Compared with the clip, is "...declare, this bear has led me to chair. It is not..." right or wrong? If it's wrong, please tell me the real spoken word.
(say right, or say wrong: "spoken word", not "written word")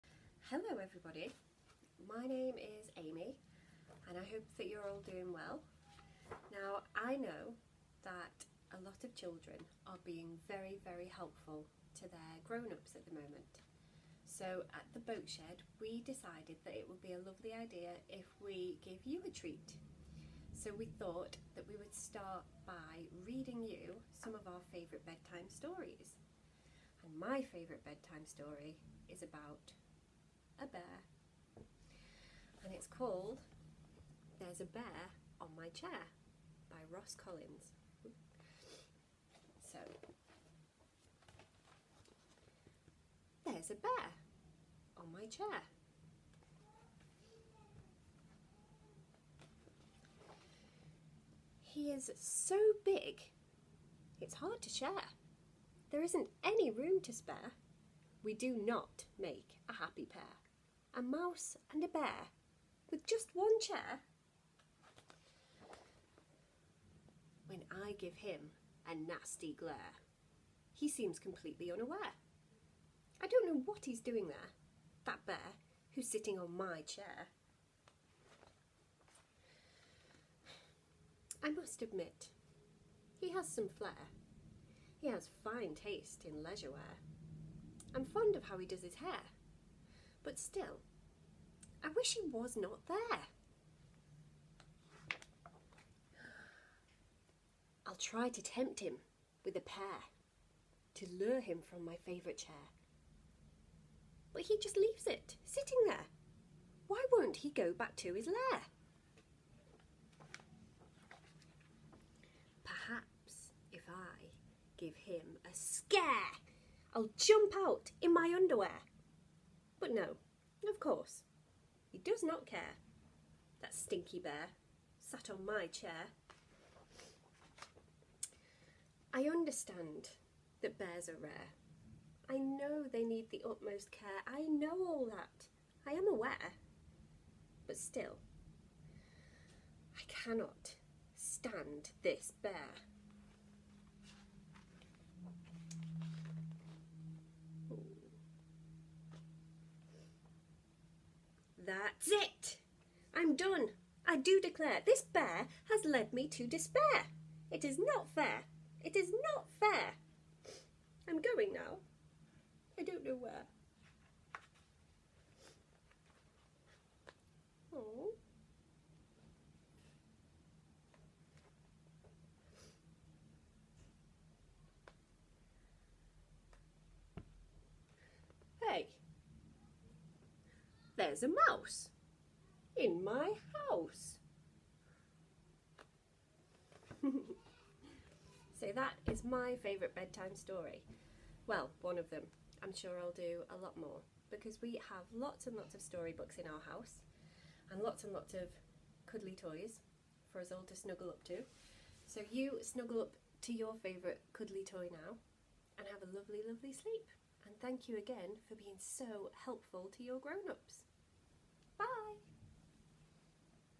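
wrong: "despair", not "chair".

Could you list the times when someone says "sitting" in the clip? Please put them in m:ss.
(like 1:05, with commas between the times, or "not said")
1:16, 1:45.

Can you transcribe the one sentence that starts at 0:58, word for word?
We do not make a happy pair a mouse and a bear with just one chair?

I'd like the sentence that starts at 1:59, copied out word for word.
But no, of course, he does not care.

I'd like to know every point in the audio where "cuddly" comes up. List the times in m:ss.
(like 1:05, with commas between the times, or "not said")
3:19, 3:24.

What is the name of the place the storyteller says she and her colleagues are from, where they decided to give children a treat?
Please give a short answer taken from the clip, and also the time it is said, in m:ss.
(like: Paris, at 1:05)
The Boat Shed, at 0:14.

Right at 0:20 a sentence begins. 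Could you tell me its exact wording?
So we thought that we would start by reading you some of our favourite bedtime stories.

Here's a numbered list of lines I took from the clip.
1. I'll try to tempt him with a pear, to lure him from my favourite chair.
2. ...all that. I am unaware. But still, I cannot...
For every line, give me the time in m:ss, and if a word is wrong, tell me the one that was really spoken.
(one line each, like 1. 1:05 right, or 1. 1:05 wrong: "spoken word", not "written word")
1. 1:37 right
2. 2:14 wrong: "aware", not "unaware".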